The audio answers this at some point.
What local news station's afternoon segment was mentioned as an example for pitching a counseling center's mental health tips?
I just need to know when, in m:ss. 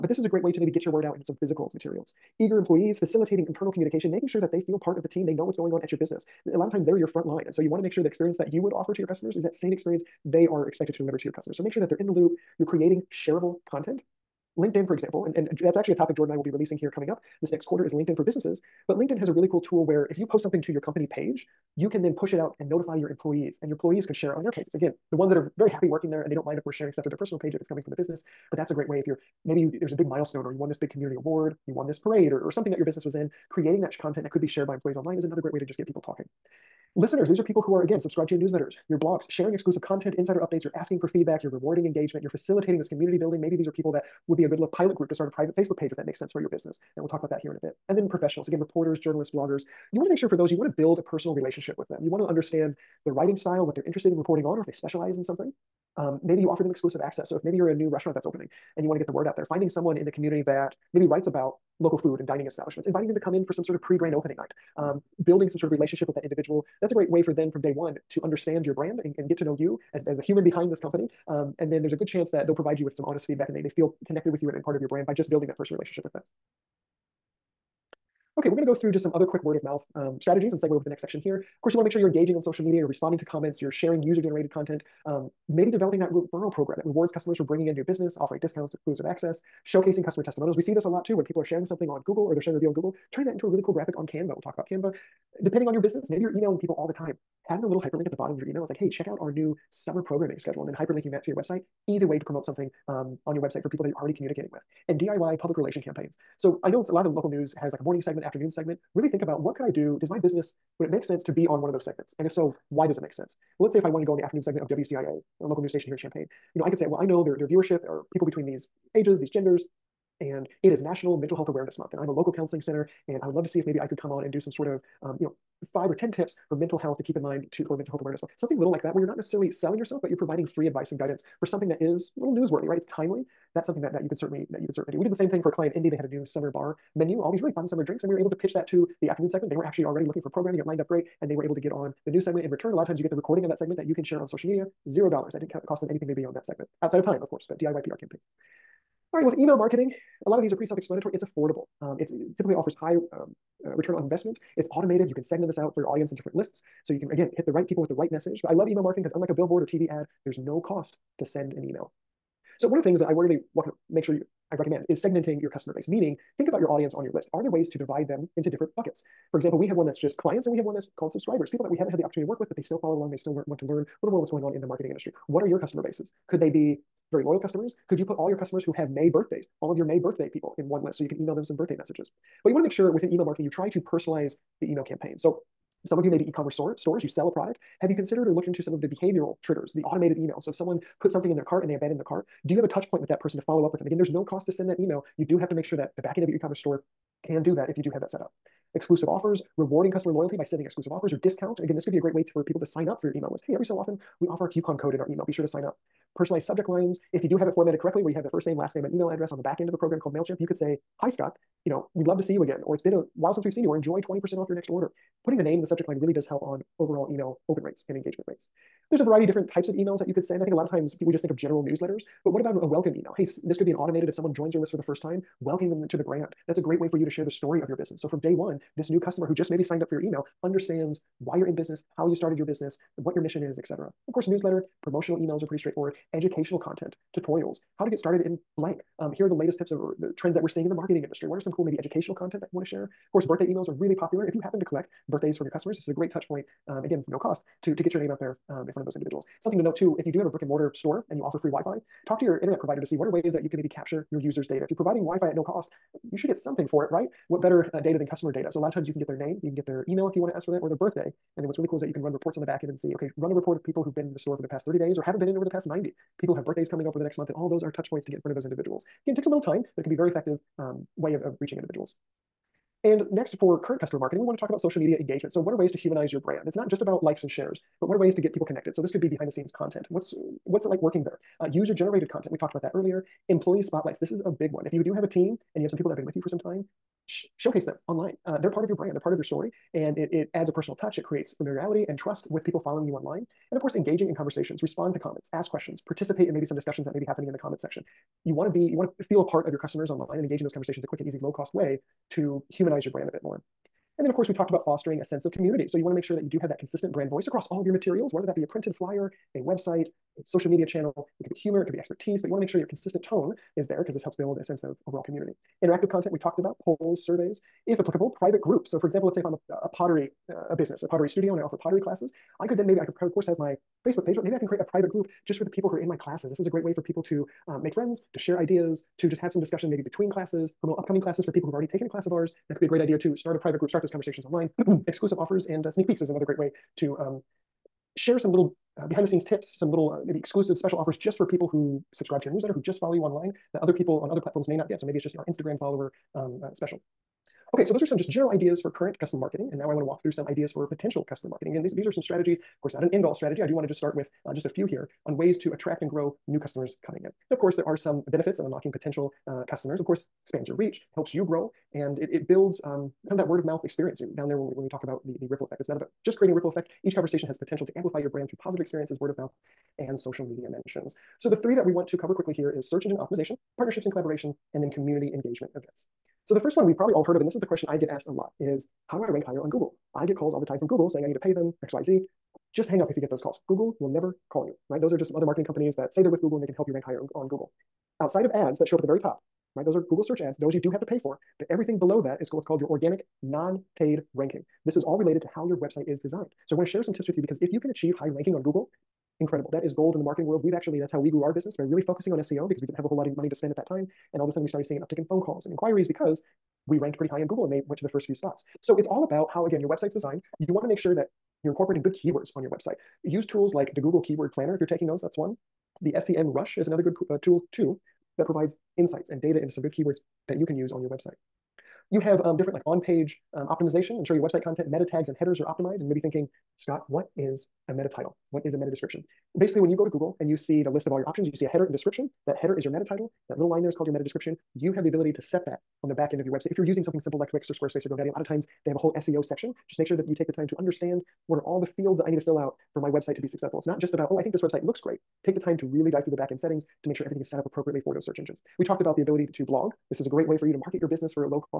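1:54.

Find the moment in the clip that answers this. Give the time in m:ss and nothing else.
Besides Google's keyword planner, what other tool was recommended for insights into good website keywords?
6:55.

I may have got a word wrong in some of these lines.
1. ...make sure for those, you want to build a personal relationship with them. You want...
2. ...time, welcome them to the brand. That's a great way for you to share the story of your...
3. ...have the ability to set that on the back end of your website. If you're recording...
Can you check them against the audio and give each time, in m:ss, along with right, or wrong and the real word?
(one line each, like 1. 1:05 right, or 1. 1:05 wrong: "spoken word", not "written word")
1. 0:50 right
2. 3:45 right
3. 7:14 wrong: "using", not "recording".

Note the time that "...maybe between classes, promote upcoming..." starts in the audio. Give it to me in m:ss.
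5:29.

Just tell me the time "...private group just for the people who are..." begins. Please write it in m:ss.
5:24.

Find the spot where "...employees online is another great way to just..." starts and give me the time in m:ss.
0:34.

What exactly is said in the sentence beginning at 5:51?
Again, these, these are some strategies, of course, not an end all strategy.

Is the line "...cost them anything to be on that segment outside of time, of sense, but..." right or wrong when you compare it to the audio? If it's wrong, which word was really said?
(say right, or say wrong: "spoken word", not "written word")
wrong: "course", not "sense".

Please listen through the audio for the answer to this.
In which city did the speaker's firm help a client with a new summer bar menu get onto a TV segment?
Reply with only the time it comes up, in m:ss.
2:15.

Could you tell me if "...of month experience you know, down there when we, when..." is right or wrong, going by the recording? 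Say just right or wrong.
wrong.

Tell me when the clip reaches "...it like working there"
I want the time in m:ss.
4:40.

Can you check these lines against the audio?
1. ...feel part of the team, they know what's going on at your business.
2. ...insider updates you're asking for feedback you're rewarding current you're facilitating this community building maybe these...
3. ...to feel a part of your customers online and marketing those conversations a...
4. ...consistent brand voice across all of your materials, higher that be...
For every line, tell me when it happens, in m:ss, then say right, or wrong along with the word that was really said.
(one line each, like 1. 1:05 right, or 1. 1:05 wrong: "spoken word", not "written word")
1. 0:04 right
2. 0:40 wrong: "engagement", not "current"
3. 4:58 wrong: "engaging", not "marketing"
4. 5:06 wrong: "whether", not "higher".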